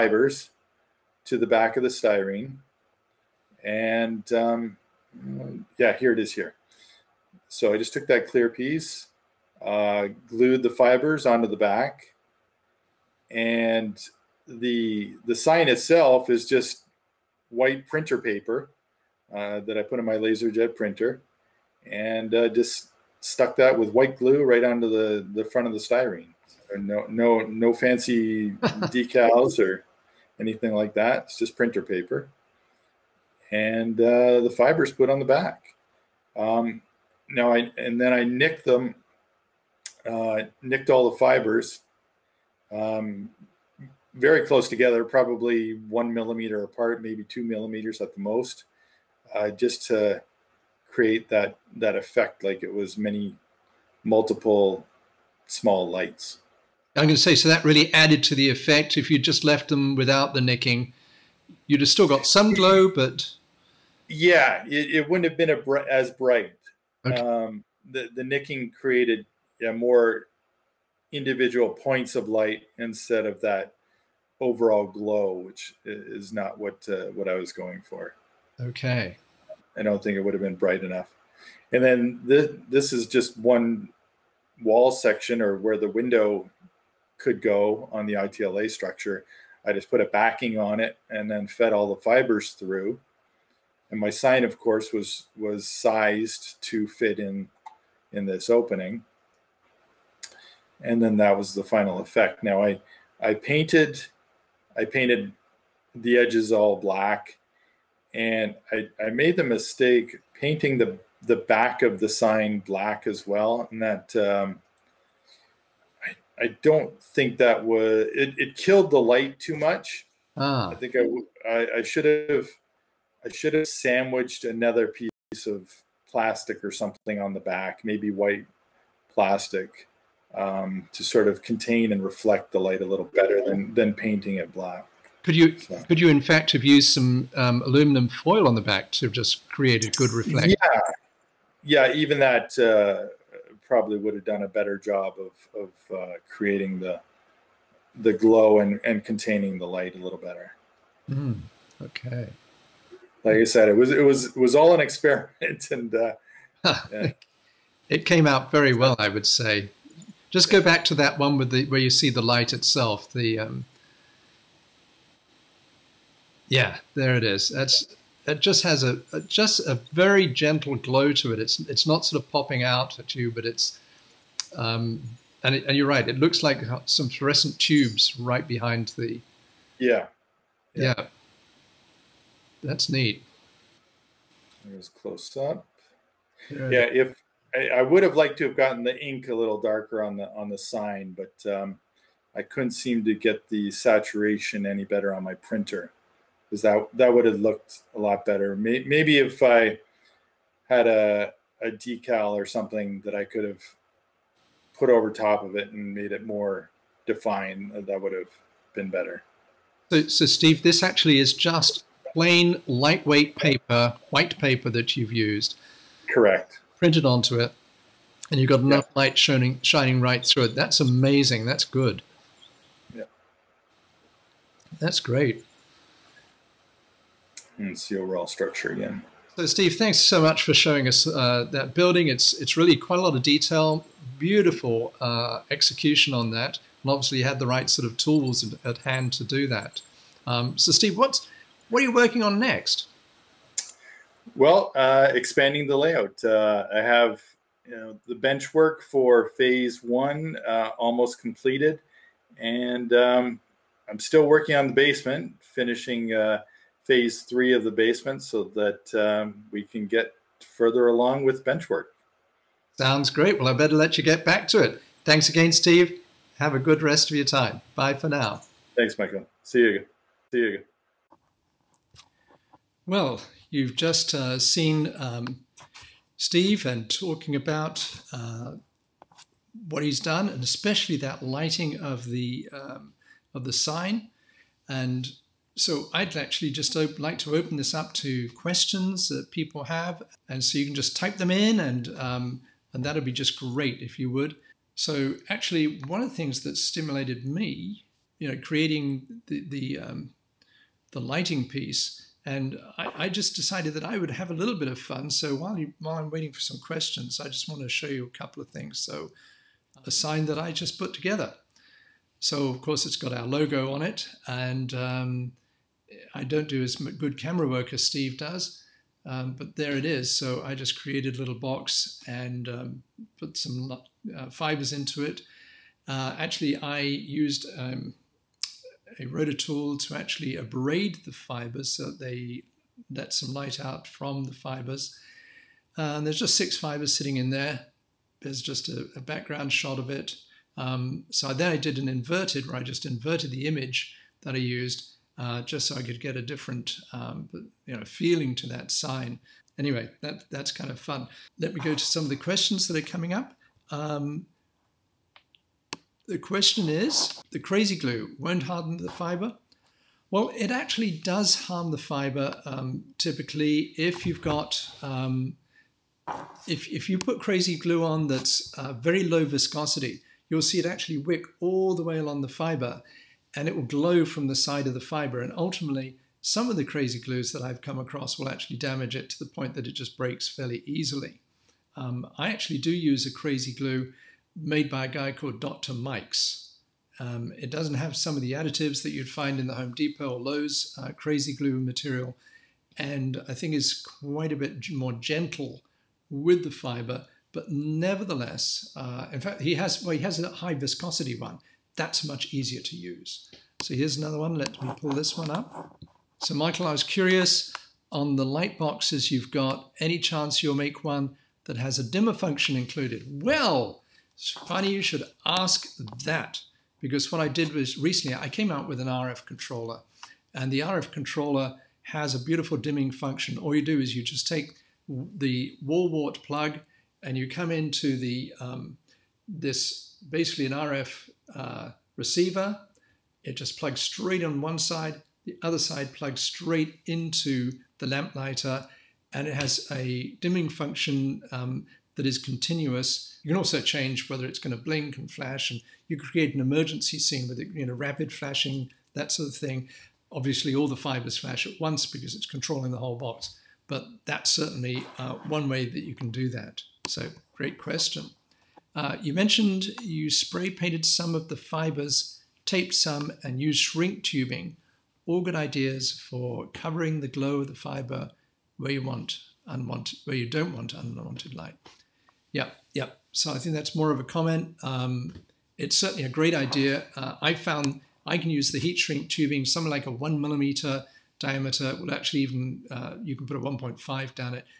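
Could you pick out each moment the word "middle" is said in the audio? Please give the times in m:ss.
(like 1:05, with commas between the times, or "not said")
not said.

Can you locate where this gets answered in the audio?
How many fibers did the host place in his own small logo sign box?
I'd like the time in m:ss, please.
5:36.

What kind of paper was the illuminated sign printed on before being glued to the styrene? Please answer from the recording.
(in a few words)
White printer paper.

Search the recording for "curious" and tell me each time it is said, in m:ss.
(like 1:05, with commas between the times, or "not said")
6:46.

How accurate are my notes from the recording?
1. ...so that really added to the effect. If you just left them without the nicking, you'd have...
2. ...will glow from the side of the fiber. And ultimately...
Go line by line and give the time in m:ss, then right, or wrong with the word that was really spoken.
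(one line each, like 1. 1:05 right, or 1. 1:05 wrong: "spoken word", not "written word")
1. 0:57 right
2. 6:13 right.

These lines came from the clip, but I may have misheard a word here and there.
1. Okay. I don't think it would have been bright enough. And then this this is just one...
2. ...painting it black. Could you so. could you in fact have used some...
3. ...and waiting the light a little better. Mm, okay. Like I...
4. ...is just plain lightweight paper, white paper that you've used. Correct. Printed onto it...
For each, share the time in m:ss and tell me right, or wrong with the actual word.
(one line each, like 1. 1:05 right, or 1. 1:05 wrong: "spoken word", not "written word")
1. 1:18 right
2. 2:13 right
3. 2:28 wrong: "containing", not "waiting"
4. 3:31 right.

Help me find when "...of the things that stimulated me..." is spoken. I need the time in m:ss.
4:56.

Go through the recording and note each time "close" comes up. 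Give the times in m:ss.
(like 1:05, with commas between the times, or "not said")
0:44, 3:04.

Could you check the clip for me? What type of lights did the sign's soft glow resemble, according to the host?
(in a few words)
Fluorescent tubes.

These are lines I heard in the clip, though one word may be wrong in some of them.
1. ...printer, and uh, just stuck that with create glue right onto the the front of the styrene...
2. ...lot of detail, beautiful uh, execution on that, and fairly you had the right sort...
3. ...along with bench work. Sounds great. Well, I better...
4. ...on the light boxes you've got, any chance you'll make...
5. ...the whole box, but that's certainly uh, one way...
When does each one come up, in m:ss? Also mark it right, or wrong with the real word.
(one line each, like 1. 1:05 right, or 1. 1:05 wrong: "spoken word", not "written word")
1. 0:20 wrong: "white", not "create"
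2. 3:53 wrong: "obviously", not "fairly"
3. 4:20 right
4. 6:47 right
5. 7:32 right.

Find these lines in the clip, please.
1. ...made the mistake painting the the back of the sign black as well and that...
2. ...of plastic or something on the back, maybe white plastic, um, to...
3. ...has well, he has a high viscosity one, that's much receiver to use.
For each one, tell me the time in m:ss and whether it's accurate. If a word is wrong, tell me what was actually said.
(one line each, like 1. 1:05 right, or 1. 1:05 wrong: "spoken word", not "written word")
1. 1:49 right
2. 2:05 right
3. 6:39 wrong: "easier", not "receiver".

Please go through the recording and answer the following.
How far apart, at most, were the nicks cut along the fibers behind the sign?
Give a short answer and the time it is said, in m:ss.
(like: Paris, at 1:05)
2 millimeters, at 0:47.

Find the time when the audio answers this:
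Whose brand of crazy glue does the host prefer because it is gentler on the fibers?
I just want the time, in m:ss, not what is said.
6:25.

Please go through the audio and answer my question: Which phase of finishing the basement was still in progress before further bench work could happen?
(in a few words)
Phase three.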